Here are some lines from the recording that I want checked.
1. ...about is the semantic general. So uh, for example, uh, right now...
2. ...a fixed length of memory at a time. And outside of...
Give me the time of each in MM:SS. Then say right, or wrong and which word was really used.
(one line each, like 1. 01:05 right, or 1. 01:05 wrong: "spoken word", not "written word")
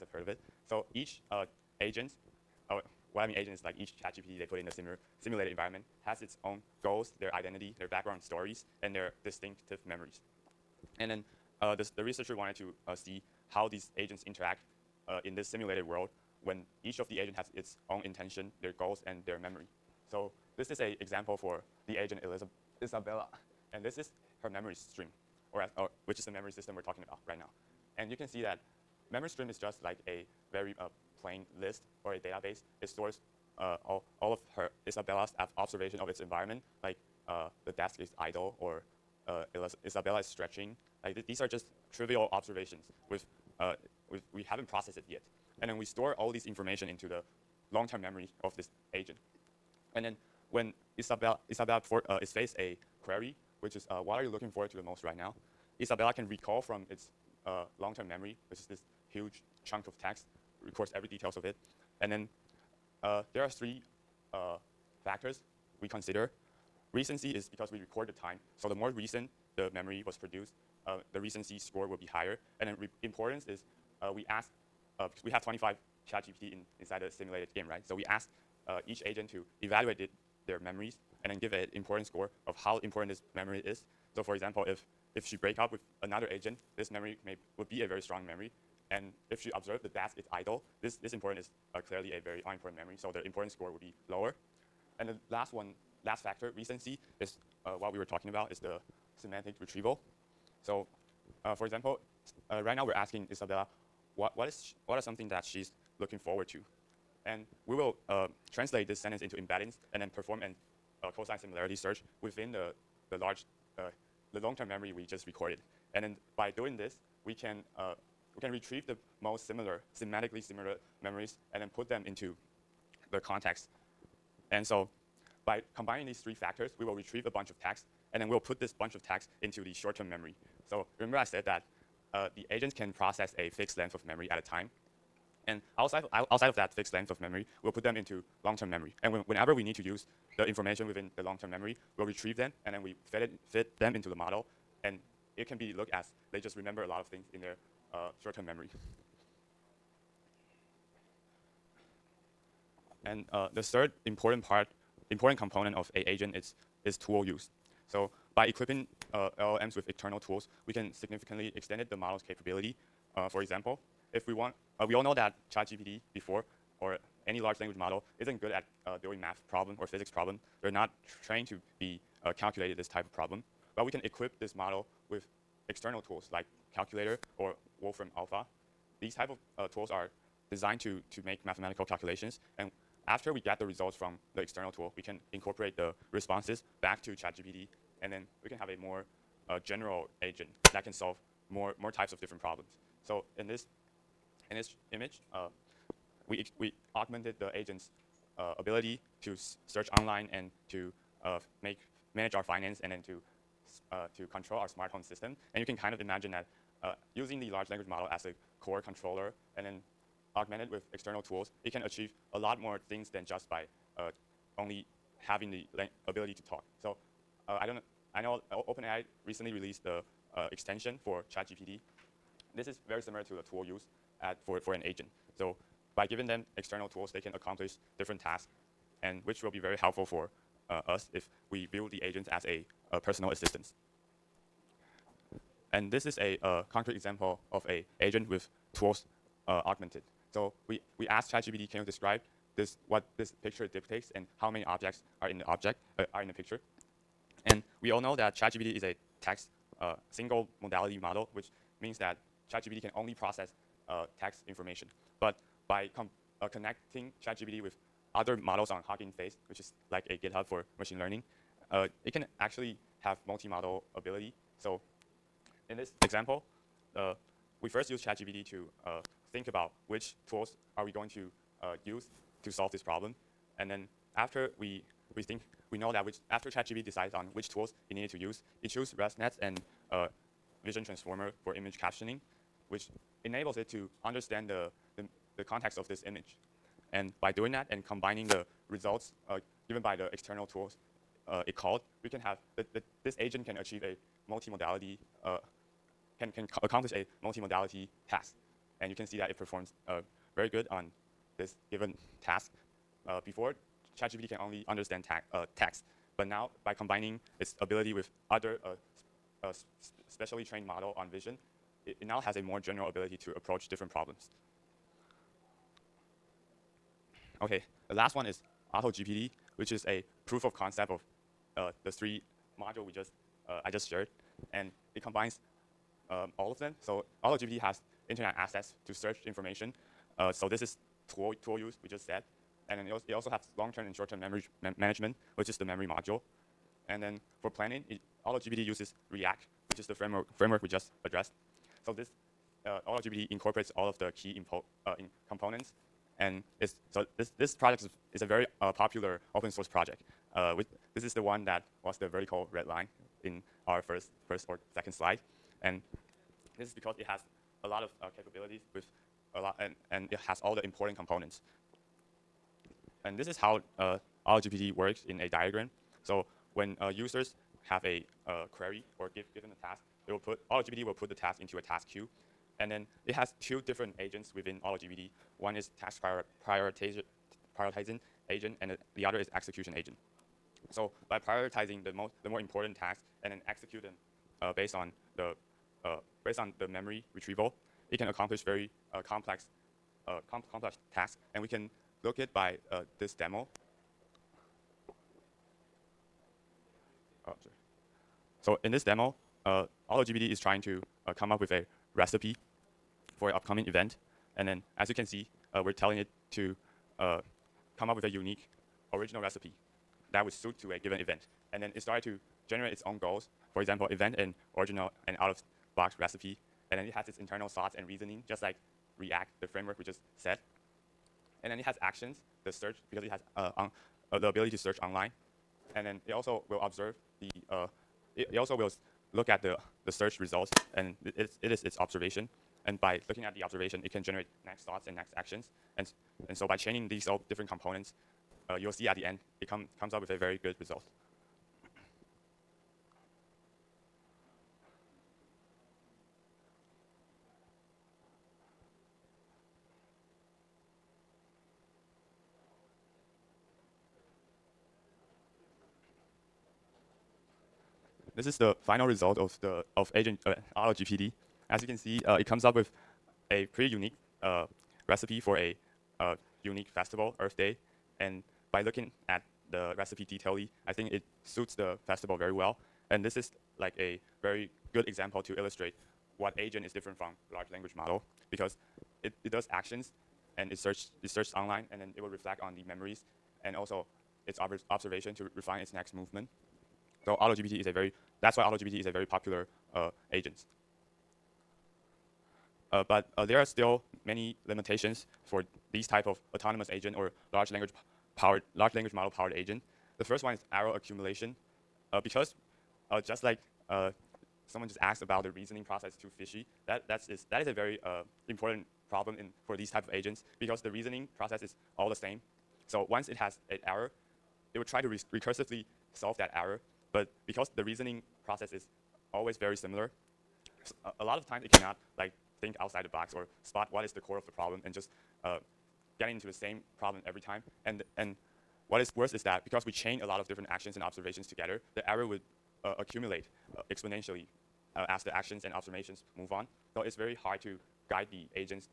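1. 01:38 wrong: "retrieval", not "general"
2. 02:13 right.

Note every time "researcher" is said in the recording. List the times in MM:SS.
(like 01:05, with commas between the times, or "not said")
00:12.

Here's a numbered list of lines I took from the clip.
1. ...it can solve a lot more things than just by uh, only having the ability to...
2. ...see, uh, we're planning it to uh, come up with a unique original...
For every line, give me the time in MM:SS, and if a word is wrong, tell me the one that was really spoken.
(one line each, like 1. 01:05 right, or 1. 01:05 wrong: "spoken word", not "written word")
1. 03:31 wrong: "achieve", not "solve"
2. 06:45 wrong: "telling", not "planning".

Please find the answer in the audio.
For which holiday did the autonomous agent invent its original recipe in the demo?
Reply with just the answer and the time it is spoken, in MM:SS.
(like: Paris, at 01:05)
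Earth Day, at 07:47.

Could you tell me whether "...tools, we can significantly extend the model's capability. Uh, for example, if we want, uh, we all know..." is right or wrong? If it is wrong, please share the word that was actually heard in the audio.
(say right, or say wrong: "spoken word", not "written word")
right.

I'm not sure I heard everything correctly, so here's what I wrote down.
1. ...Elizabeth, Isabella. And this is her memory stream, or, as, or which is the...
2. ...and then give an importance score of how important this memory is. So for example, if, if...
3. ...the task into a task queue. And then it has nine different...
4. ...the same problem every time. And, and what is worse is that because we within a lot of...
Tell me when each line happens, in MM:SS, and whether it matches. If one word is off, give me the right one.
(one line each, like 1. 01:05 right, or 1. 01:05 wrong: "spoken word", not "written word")
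1. 00:22 right
2. 01:21 right
3. 06:11 wrong: "two", not "nine"
4. 08:46 wrong: "chain", not "within".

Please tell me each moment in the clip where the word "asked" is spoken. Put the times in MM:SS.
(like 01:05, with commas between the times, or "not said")
04:01, 08:24.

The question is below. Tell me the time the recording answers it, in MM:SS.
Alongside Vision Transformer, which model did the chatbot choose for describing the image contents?
04:38.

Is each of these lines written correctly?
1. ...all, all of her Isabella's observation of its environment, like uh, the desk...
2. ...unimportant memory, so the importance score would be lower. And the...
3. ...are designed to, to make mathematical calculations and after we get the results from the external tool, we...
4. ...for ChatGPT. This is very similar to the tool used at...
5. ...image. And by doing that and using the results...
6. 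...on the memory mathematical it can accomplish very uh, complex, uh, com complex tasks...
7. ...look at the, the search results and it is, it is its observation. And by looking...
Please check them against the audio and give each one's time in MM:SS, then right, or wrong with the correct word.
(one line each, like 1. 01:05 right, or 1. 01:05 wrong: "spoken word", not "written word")
1. 00:33 right
2. 01:32 right
3. 02:59 right
4. 03:41 right
5. 04:46 wrong: "combining", not "using"
6. 06:26 wrong: "retrieval", not "mathematical"
7. 07:09 right.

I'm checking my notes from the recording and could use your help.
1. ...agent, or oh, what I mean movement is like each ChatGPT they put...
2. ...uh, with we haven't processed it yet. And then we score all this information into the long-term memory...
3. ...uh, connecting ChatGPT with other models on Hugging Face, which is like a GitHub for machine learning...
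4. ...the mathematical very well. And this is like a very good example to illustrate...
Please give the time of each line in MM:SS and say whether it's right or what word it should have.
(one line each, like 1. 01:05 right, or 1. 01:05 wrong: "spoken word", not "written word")
1. 00:01 wrong: "agent", not "movement"
2. 00:43 wrong: "store", not "score"
3. 04:16 right
4. 07:51 wrong: "festival", not "mathematical".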